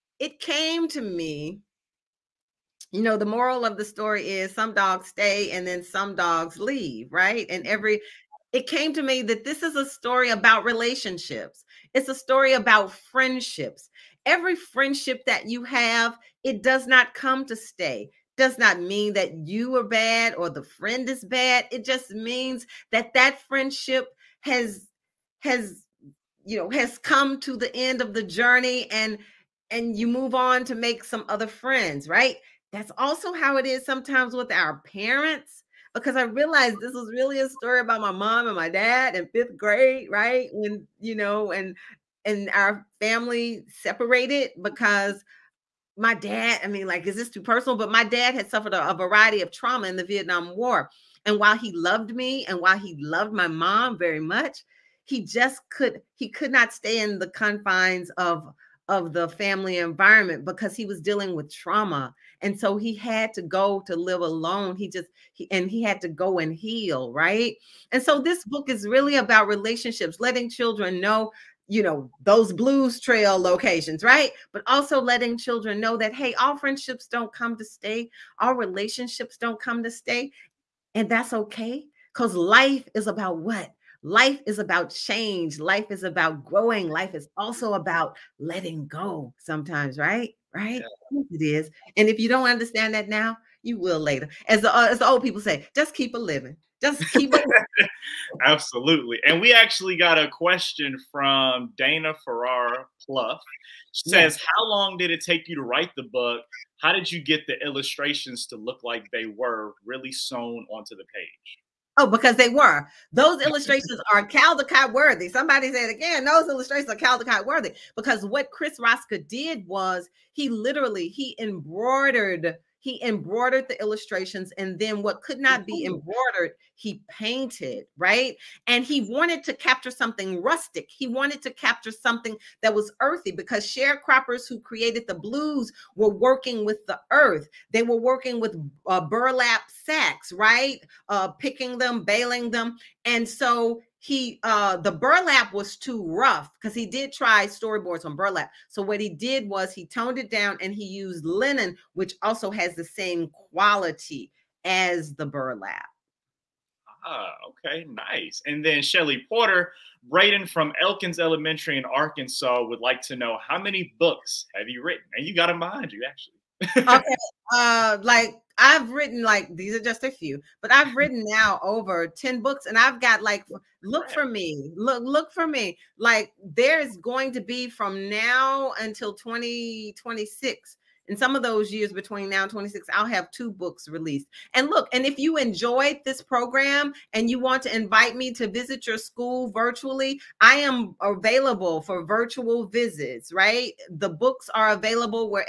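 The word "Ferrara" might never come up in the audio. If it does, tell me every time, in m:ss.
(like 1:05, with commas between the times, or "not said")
1:42.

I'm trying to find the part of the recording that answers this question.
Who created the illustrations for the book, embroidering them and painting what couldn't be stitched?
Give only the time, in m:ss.
1:58.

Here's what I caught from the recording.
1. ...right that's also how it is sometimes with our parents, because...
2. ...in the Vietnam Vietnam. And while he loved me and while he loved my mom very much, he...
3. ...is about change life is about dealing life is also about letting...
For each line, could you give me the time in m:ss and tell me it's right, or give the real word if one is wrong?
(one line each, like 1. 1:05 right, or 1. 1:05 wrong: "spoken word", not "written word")
1. 0:32 right
2. 0:49 wrong: "War", not "Vietnam"
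3. 1:24 wrong: "growing", not "dealing".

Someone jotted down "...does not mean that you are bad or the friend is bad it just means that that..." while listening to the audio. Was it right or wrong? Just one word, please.
right.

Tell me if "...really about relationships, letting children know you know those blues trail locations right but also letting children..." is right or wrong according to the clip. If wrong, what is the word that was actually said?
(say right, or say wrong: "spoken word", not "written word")
right.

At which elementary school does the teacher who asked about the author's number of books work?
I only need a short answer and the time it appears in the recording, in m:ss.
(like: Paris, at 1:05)
Elkins Elementary, at 2:40.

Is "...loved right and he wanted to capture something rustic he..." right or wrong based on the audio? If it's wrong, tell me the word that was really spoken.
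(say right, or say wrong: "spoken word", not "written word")
wrong: "painted", not "loved".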